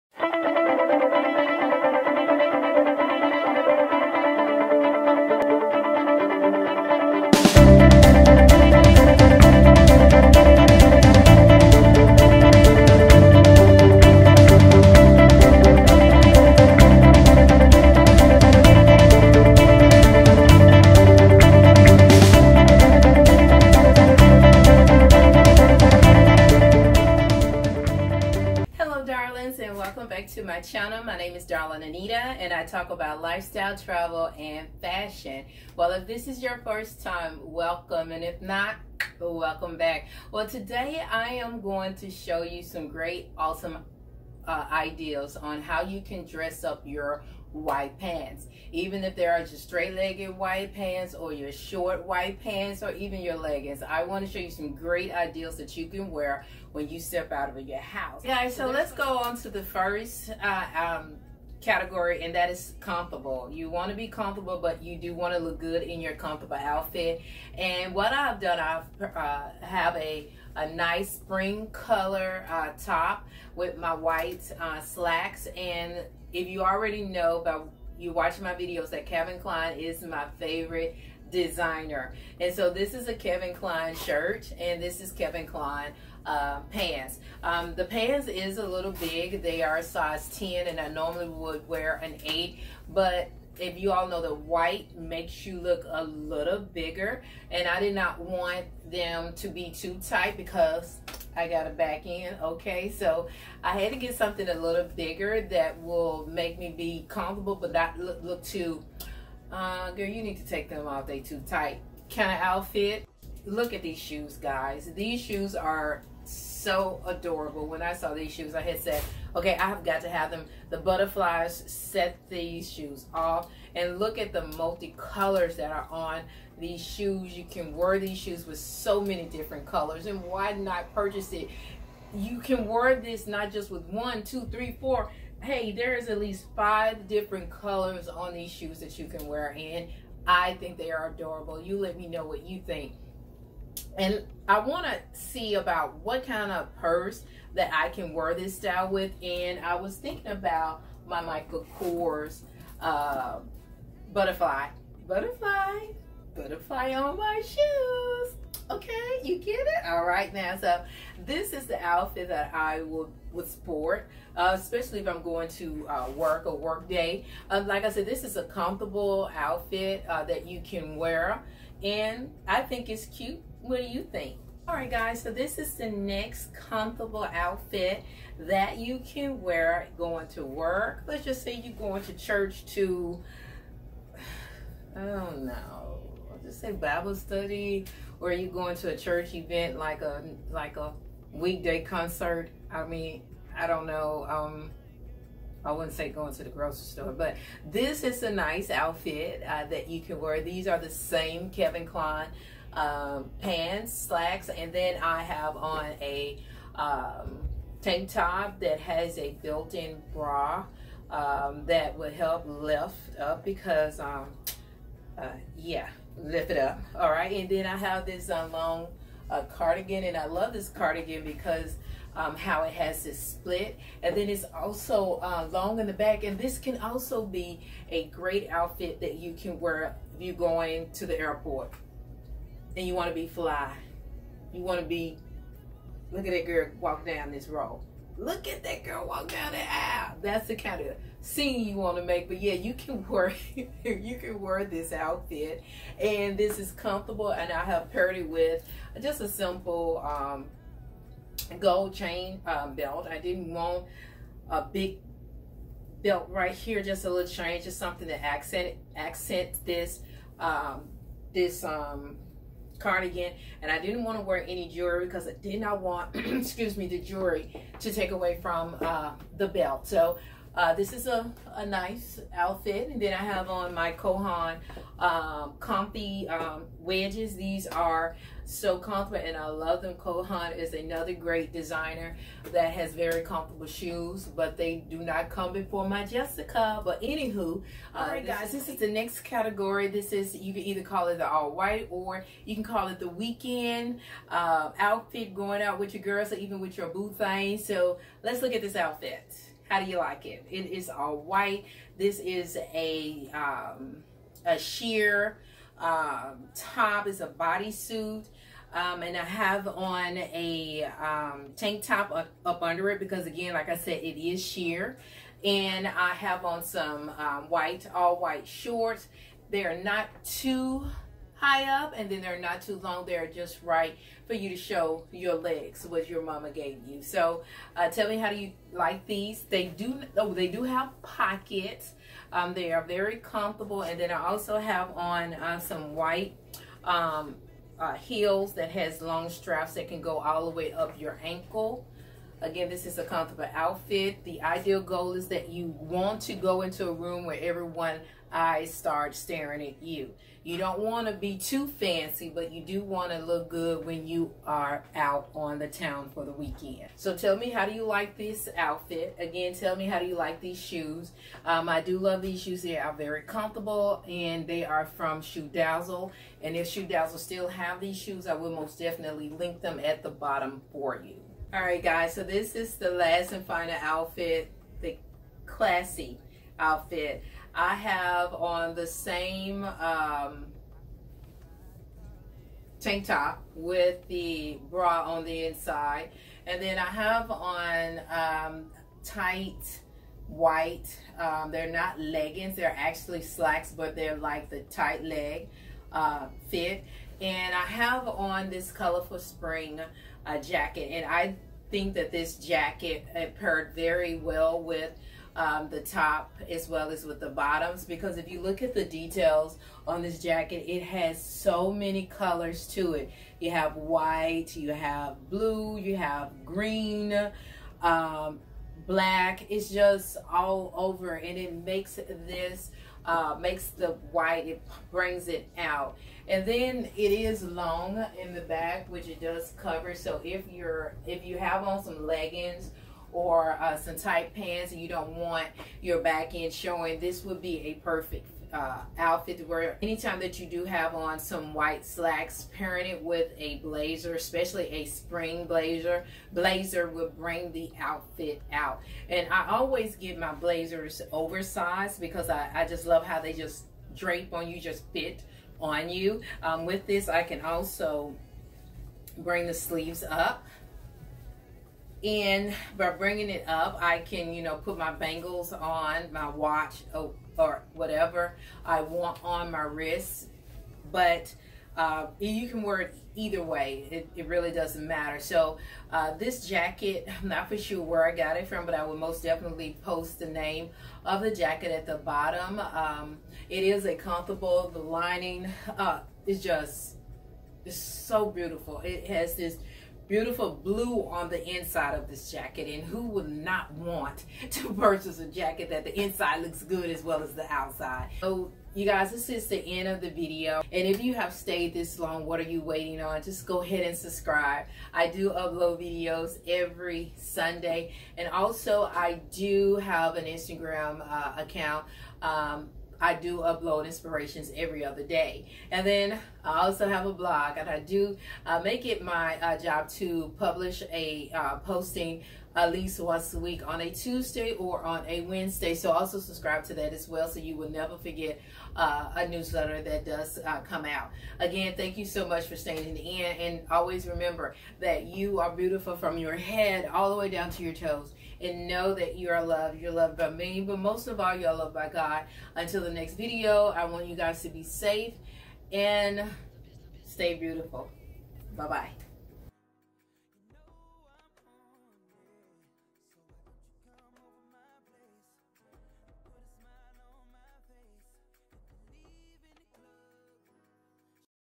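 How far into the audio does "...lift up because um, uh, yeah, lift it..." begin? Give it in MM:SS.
03:32.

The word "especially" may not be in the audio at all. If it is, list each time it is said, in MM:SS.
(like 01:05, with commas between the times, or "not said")
02:44, 07:24.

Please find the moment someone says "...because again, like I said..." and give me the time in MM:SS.
05:12.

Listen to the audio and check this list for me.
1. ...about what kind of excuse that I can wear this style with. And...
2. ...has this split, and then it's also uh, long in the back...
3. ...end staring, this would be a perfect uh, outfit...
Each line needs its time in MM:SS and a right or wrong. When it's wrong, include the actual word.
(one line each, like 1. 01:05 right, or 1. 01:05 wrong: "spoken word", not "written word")
1. 02:25 wrong: "purse", not "excuse"
2. 03:42 right
3. 07:16 wrong: "showing", not "staring".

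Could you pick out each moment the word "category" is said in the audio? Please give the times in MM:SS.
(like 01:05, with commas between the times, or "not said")
01:01, 04:49.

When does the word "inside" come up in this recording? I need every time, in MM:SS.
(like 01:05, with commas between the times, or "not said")
06:25, 08:11, 08:15.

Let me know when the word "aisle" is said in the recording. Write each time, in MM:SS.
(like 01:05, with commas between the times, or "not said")
03:59.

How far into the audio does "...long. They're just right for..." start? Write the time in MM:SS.
05:22.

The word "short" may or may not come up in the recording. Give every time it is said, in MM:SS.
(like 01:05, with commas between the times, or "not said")
00:51, 05:18.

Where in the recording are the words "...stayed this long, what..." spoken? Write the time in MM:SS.
08:21.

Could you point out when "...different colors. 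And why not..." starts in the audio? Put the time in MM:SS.
02:09.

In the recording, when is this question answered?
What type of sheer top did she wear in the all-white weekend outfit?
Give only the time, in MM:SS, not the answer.
05:07.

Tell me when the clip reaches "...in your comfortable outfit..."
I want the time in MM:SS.
01:05.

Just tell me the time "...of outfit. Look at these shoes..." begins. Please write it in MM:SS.
01:52.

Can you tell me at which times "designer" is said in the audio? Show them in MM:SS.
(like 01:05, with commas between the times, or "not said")
01:21, 04:41.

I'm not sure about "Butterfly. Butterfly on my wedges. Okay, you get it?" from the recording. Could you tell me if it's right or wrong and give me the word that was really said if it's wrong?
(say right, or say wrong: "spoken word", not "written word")
wrong: "shoes", not "wedges".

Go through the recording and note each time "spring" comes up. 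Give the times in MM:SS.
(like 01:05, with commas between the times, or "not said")
01:11, 06:39, 07:24.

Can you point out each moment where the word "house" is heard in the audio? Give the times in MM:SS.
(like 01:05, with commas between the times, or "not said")
00:57.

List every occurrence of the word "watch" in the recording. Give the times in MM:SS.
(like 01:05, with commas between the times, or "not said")
01:18, 07:46.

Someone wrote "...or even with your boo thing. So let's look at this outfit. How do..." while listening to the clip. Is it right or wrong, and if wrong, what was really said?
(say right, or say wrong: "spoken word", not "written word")
right.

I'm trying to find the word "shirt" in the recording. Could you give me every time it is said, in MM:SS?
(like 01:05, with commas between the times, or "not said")
01:23.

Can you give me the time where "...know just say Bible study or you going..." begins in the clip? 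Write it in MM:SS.
03:05.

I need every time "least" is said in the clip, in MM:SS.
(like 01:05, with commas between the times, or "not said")
02:16, 08:42.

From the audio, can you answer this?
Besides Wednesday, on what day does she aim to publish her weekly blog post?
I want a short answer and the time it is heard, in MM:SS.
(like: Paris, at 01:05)
Tuesday, at 08:43.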